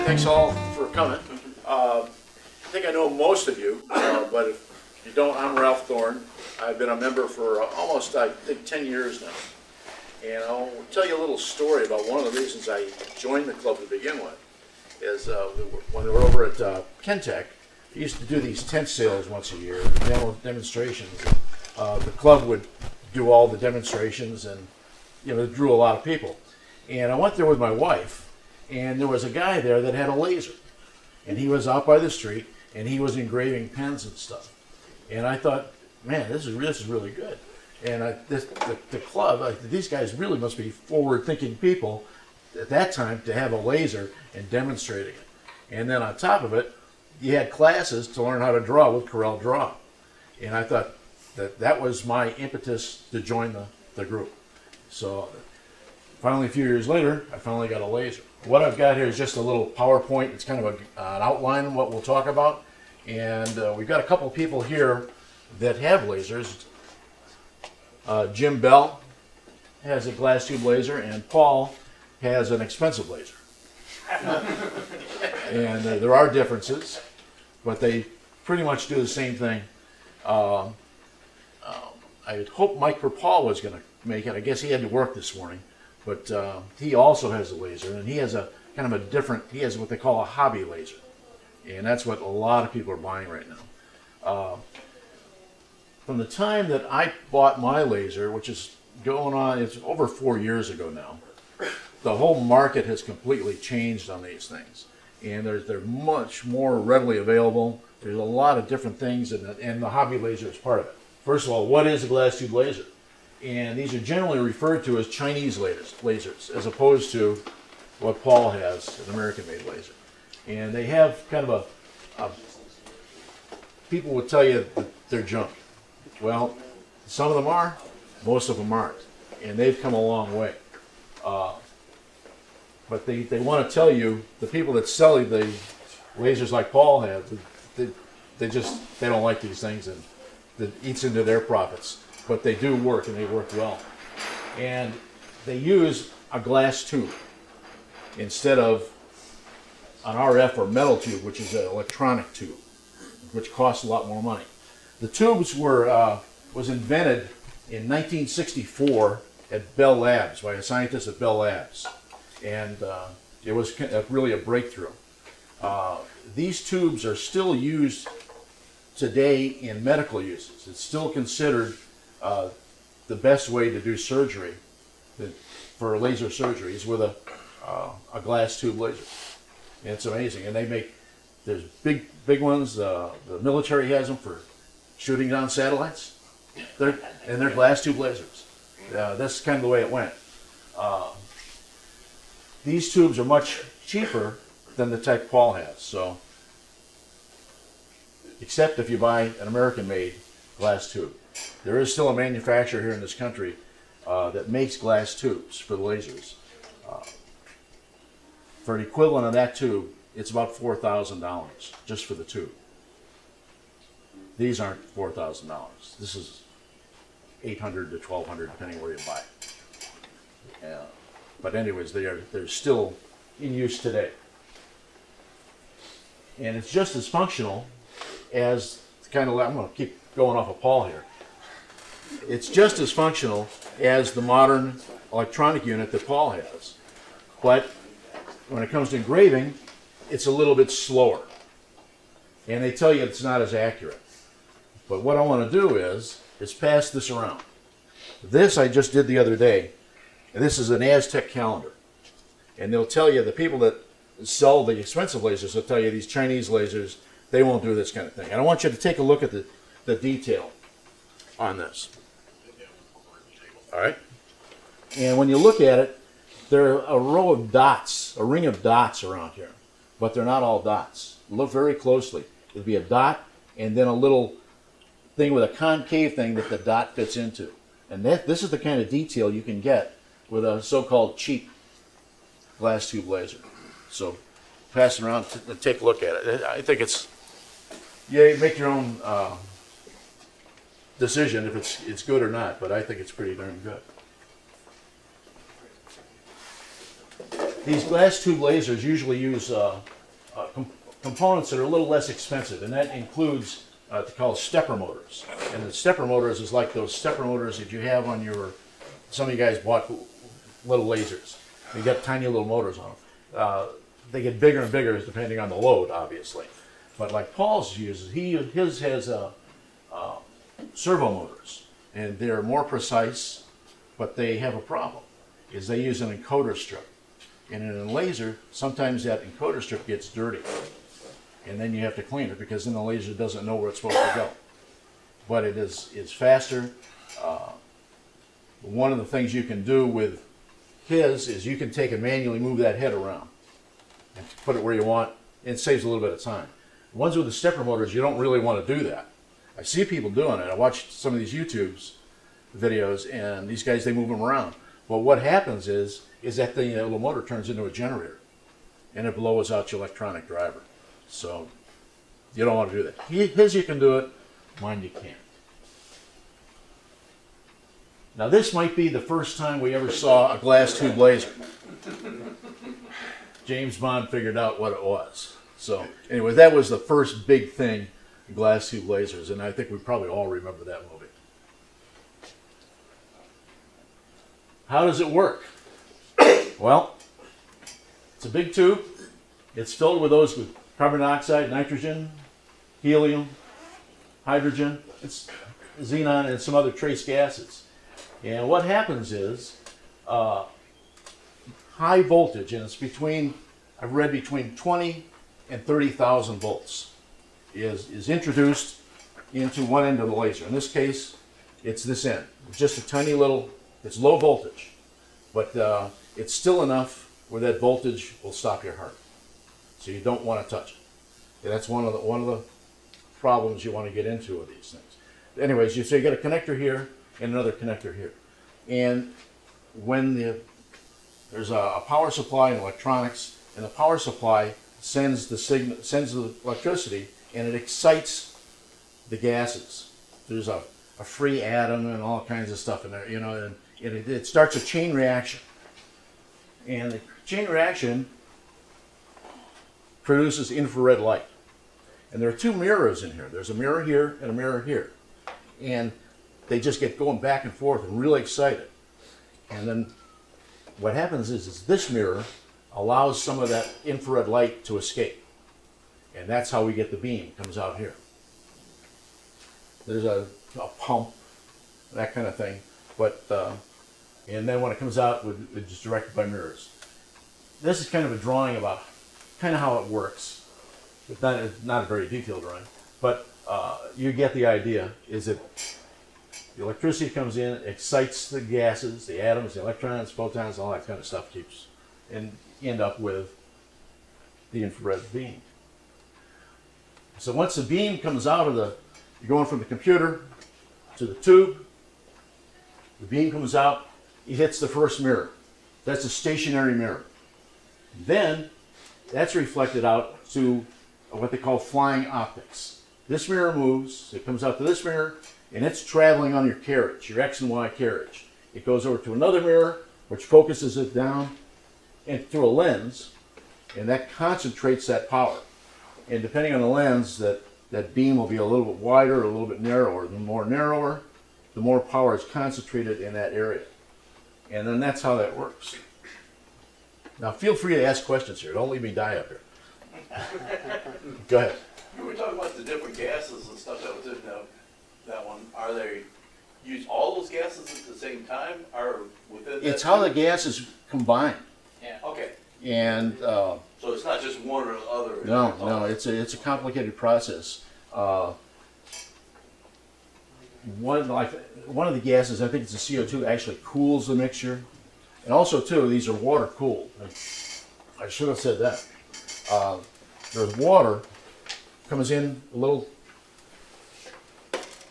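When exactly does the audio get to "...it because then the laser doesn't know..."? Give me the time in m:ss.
5:32.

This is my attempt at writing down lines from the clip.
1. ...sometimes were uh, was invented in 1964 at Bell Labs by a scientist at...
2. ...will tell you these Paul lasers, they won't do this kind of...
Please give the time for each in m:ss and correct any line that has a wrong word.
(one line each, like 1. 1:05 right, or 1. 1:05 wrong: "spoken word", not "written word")
1. 2:35 wrong: "tubes", not "sometimes"
2. 4:15 wrong: "Chinese", not "Paul".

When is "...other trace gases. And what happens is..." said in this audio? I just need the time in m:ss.
6:36.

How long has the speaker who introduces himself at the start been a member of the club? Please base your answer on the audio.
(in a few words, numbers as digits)
almost 10 years.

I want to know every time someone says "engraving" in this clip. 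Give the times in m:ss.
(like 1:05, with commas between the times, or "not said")
0:33, 3:58.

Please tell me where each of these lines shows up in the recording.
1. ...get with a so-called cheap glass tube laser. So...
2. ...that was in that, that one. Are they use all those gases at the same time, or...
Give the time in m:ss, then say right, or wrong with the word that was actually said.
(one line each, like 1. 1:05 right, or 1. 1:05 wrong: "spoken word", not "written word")
1. 4:39 right
2. 9:03 right.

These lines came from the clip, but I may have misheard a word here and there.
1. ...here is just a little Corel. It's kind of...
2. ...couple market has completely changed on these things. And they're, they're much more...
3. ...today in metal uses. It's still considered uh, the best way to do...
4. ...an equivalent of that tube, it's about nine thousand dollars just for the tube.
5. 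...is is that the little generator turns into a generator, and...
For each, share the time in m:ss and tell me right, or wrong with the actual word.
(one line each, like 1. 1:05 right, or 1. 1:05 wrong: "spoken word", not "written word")
1. 0:58 wrong: "PowerPoint", not "Corel"
2. 1:42 wrong: "whole", not "couple"
3. 2:48 wrong: "medical", not "metal"
4. 3:28 wrong: "four", not "nine"
5. 5:55 wrong: "motor", not "generator".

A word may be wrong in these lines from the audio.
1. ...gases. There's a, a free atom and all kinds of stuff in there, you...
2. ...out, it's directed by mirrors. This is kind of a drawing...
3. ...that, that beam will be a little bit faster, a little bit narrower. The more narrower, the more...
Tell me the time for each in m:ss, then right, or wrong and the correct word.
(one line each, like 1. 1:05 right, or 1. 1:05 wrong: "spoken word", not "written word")
1. 7:19 right
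2. 7:54 right
3. 8:47 wrong: "wider", not "faster".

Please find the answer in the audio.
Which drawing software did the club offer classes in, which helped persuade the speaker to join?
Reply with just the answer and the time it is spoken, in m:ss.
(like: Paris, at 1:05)
Corel Draw, at 0:49.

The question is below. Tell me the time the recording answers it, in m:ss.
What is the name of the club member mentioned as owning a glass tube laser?
1:08.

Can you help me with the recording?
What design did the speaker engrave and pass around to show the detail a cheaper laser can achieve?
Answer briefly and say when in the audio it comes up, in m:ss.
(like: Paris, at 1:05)
Aztec calendar, at 4:10.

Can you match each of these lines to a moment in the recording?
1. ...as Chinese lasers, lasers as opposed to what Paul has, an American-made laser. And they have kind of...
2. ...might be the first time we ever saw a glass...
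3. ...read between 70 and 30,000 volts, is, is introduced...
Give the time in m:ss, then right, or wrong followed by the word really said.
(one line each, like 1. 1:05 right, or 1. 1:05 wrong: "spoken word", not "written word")
1. 1:54 right
2. 6:08 right
3. 6:43 wrong: "20", not "70".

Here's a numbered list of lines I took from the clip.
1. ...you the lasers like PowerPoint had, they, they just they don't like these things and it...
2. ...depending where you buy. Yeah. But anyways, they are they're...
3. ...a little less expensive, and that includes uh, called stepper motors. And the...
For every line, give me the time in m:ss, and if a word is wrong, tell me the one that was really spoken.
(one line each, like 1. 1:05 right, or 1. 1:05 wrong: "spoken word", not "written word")
1. 2:15 wrong: "Paul", not "PowerPoint"
2. 3:38 right
3. 5:01 right.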